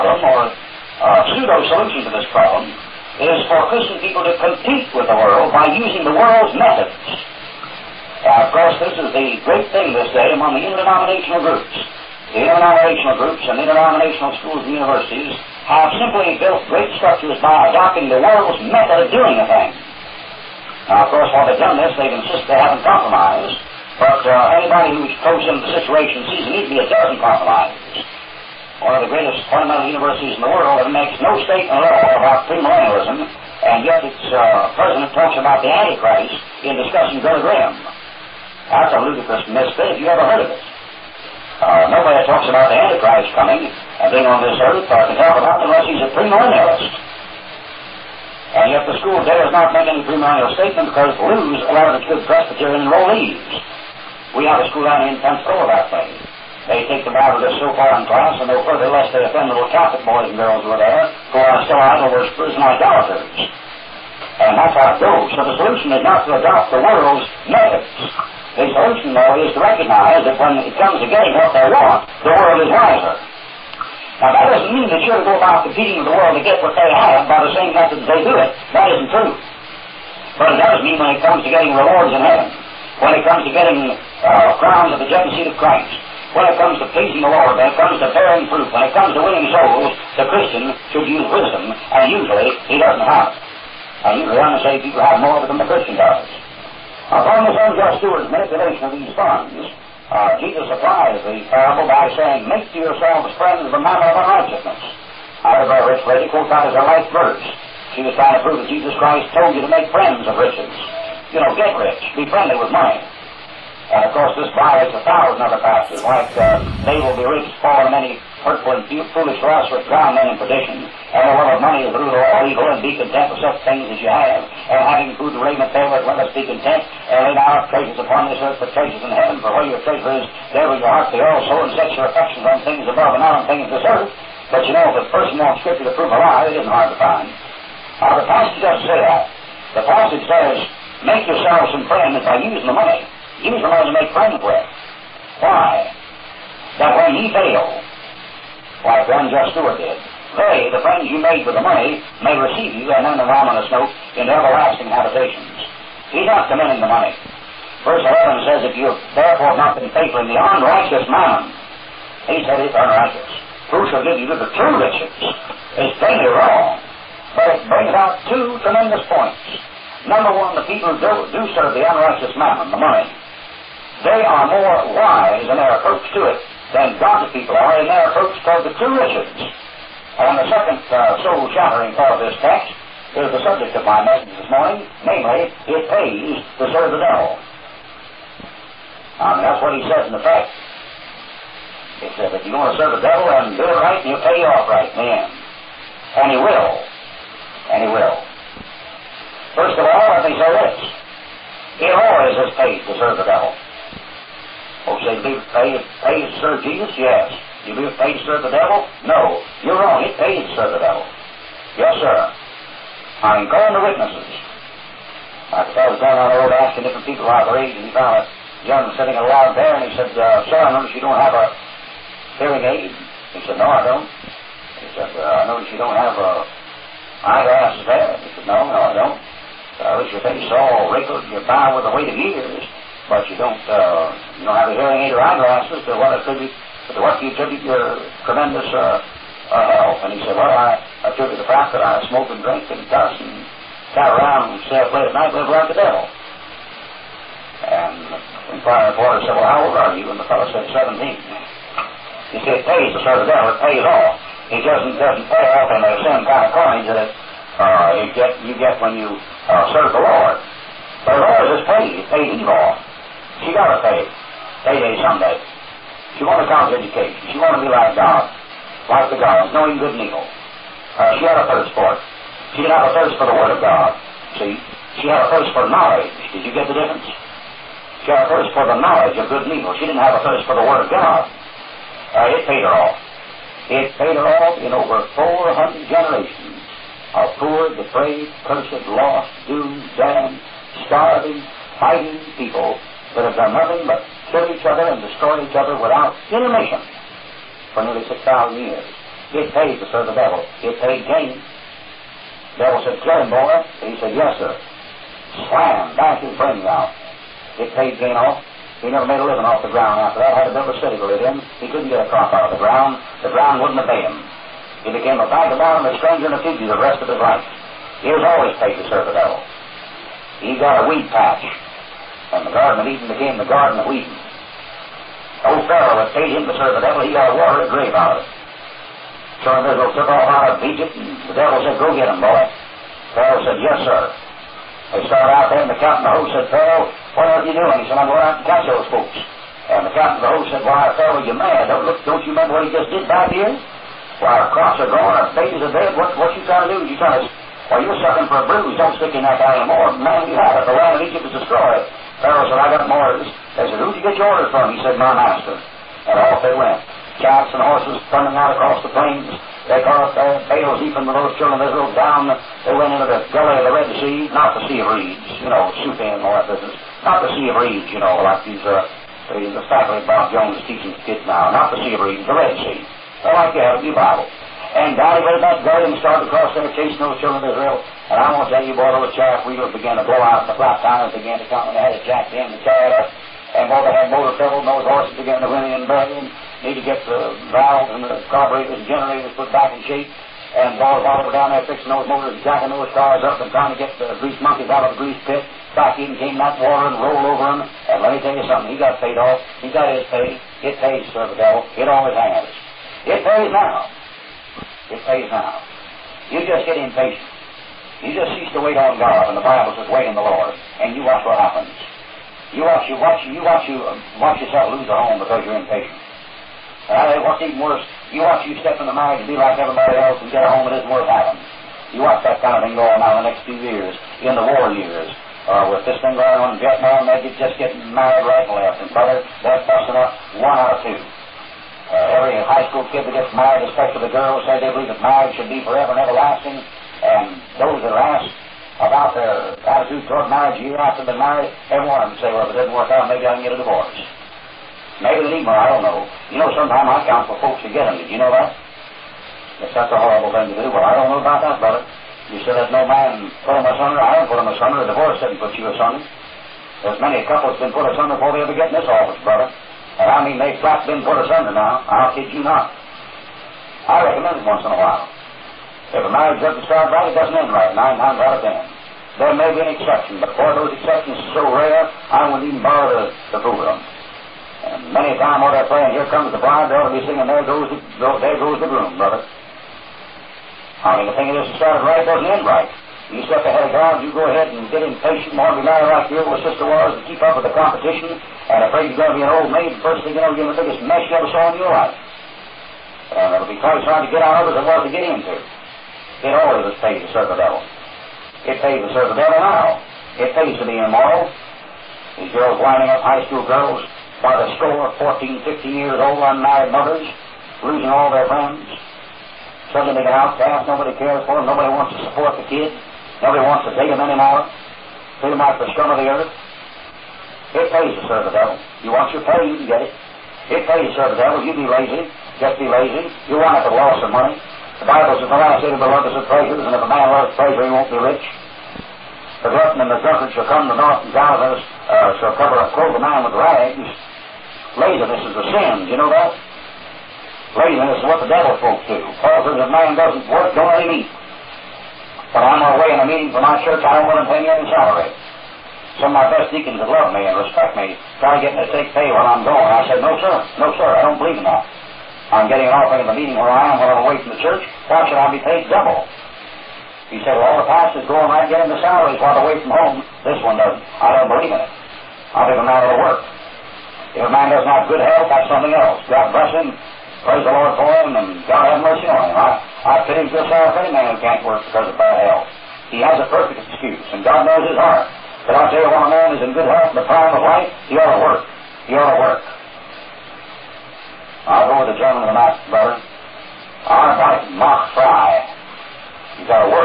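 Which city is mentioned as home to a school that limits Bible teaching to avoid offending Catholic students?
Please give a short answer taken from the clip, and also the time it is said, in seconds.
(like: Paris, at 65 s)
Pensacola, at 55 s.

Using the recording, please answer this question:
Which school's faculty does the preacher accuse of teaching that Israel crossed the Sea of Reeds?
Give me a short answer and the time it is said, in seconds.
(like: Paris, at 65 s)
Bob Jones, at 370 s.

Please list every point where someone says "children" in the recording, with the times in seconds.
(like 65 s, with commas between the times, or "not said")
361 s, 377 s.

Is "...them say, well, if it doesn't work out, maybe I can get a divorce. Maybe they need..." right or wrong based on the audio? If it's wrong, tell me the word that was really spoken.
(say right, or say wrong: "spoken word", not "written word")
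right.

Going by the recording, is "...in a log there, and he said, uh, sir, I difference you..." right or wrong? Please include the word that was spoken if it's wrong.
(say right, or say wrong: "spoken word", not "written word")
wrong: "notice", not "difference".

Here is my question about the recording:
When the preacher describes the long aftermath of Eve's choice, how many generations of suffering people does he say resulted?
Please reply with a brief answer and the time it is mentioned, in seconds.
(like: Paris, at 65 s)
400, at 285 s.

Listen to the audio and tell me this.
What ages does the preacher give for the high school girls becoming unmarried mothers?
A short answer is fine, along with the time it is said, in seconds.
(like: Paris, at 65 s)
14, 15, at 504 s.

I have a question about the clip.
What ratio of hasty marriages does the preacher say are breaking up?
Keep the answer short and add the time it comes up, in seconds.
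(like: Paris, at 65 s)
one out of two, at 430 s.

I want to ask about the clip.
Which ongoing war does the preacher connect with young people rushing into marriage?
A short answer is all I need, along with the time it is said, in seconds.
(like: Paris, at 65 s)
Vietnam, at 426 s.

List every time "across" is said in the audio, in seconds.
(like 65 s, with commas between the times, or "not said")
358 s, 376 s.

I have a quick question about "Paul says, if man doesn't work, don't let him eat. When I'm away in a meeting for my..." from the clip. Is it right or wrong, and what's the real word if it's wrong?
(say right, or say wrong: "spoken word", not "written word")
right.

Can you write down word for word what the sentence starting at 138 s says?
Now, the passage doesn't say that.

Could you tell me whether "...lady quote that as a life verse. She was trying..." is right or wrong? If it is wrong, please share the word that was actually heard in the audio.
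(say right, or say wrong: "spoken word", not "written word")
right.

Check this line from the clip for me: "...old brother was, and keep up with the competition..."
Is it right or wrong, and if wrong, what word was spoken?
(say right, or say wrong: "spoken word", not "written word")
wrong: "sister", not "brother".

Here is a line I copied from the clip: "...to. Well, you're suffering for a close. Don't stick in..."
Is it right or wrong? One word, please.
wrong.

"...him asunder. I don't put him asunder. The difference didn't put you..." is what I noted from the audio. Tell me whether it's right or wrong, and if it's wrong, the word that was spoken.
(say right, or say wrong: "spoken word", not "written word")
wrong: "divorce", not "difference".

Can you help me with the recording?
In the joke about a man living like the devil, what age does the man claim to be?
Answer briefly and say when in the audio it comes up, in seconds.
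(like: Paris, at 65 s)
17, at 250 s.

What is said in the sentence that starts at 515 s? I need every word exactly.
Treat them like the scum of the earth.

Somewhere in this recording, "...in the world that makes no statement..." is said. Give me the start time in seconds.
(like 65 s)
30 s.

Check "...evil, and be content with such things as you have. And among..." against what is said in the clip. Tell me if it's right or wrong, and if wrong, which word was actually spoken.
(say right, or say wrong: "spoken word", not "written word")
wrong: "having", not "among".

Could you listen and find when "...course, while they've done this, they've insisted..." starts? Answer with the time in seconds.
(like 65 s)
21 s.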